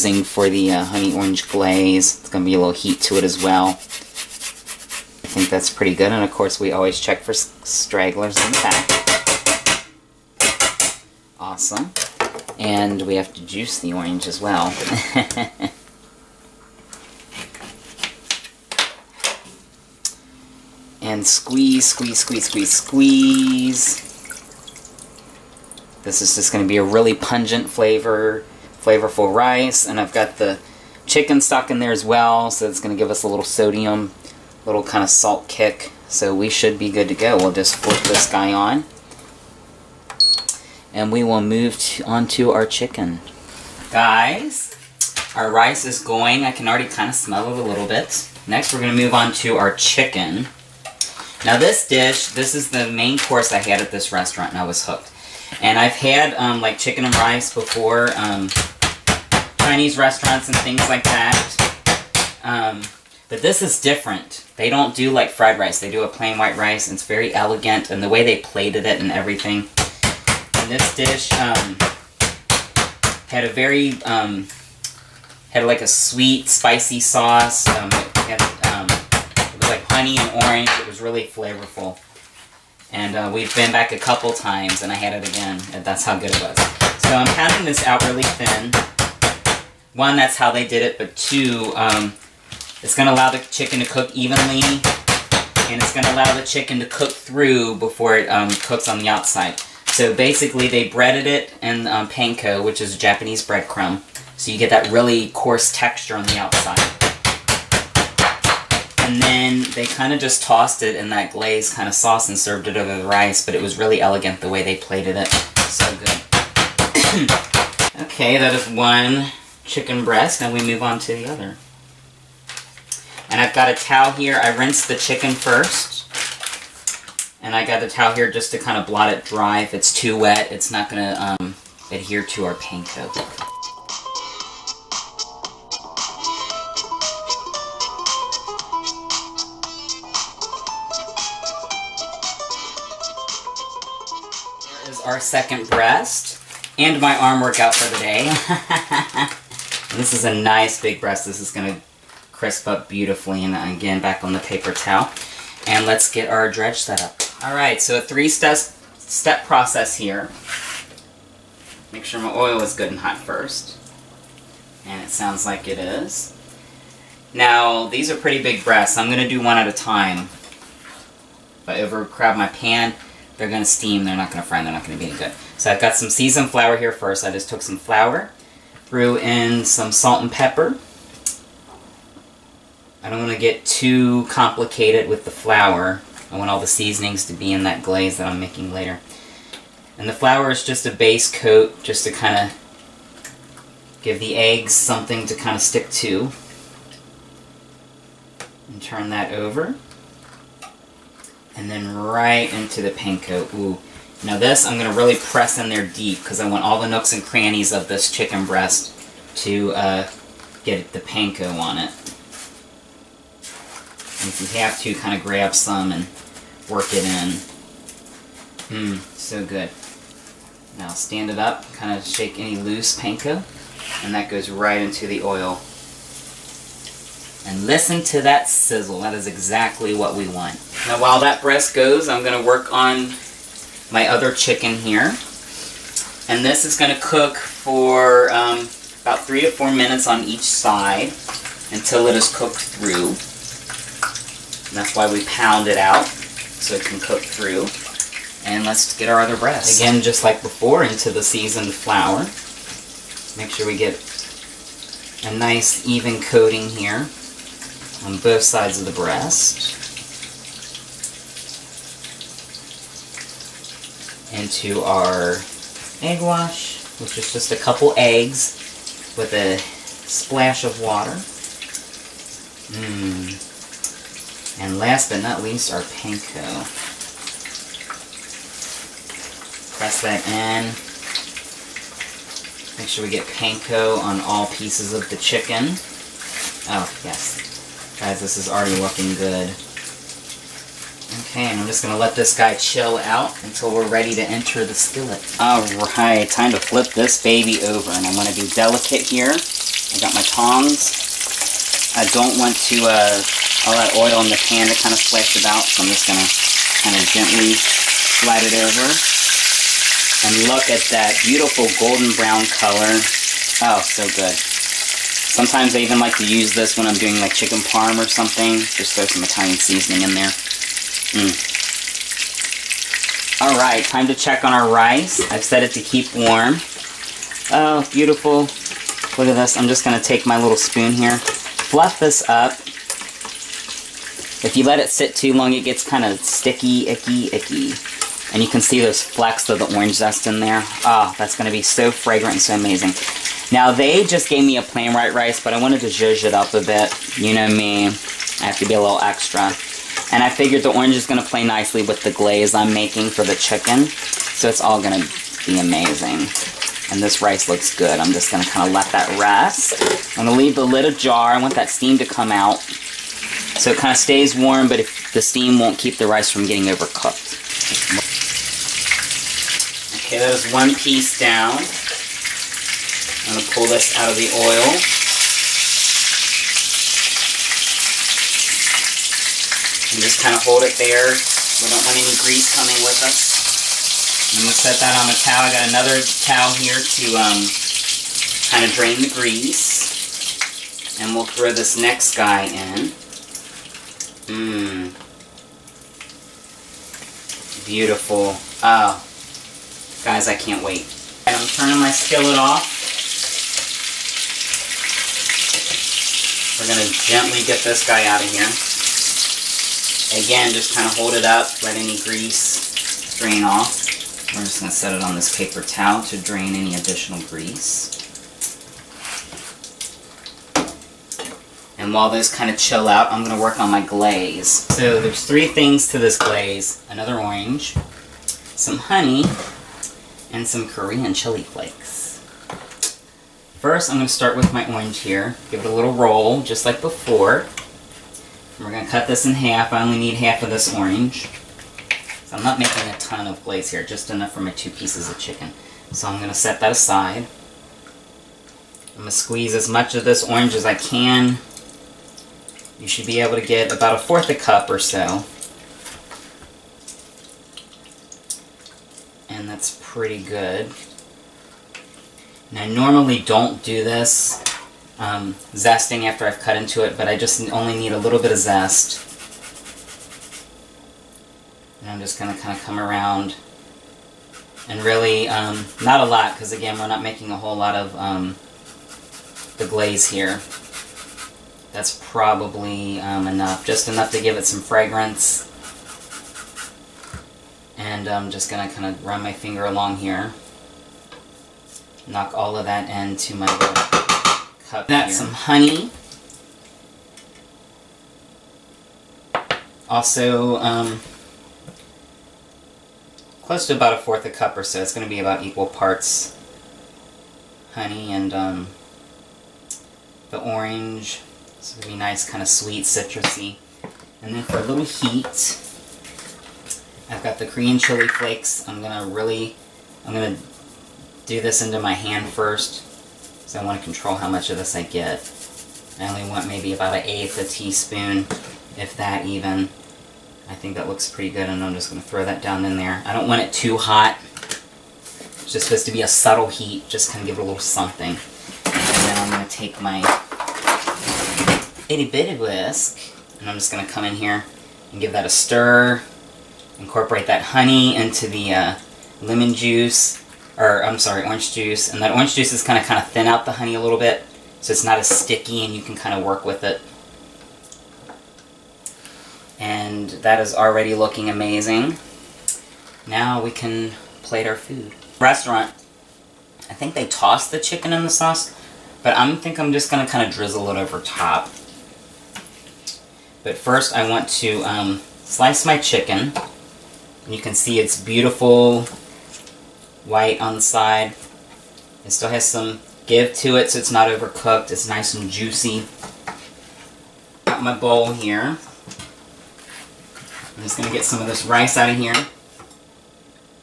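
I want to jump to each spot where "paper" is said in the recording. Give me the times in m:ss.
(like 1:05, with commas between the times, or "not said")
2:34, 6:55.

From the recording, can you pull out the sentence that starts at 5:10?
And look at that beautiful golden brown color.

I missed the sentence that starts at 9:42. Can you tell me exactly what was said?
It still has some give to it so it's not overcooked.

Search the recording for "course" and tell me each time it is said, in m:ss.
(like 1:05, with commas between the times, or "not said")
0:06, 0:53.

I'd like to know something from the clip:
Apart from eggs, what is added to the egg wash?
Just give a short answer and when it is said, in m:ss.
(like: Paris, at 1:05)
a splash of water, at 4:30.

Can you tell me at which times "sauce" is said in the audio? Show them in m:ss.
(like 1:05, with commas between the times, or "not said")
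1:17, 1:51, 9:28.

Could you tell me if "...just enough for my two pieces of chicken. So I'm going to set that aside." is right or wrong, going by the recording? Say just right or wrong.
right.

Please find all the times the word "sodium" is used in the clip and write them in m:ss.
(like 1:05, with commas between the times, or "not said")
0:33.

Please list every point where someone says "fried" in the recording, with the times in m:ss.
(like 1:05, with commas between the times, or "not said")
1:05.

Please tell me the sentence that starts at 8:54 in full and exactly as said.
It's just supposed to be a subtle heat, just kind of give it a little something.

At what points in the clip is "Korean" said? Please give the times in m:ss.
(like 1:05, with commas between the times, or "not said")
7:10, 8:37.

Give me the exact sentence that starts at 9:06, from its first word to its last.
Incorporate that honey into the uh, lemon juice, or I'm sorry, orange juice.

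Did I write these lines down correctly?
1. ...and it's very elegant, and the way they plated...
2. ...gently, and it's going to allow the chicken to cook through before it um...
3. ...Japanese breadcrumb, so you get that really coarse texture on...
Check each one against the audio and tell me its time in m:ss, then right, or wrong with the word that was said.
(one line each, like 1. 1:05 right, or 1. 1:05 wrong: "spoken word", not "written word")
1. 1:06 right
2. 1:34 wrong: "evenly", not "gently"
3. 1:42 right.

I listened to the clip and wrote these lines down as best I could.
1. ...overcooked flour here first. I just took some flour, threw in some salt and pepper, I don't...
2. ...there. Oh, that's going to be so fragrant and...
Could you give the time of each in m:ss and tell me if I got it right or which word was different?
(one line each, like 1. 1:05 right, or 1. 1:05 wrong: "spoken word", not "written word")
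1. 2:56 wrong: "seasoned", not "overcooked"
2. 5:40 right.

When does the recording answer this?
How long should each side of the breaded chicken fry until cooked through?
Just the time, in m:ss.
3:59.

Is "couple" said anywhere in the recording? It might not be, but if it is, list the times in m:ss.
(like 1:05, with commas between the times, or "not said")
1:23, 4:27.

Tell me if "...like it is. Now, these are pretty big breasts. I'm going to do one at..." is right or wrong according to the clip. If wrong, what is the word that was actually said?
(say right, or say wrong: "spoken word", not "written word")
right.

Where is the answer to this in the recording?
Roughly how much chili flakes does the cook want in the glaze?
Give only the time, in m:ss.
8:46.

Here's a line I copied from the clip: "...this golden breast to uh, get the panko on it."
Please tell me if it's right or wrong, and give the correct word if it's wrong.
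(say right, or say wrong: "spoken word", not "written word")
wrong: "chicken", not "golden".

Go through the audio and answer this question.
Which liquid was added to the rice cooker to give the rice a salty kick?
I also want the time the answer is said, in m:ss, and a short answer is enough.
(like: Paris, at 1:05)
chicken stock, at 0:31.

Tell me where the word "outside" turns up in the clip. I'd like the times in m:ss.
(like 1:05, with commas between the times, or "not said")
1:39, 1:46.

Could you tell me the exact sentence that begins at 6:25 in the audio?
I got another towel here to um, kind of drain the grease.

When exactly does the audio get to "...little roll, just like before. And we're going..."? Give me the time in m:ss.
7:15.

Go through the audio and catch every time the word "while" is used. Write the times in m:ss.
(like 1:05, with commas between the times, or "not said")
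3:51, 7:01.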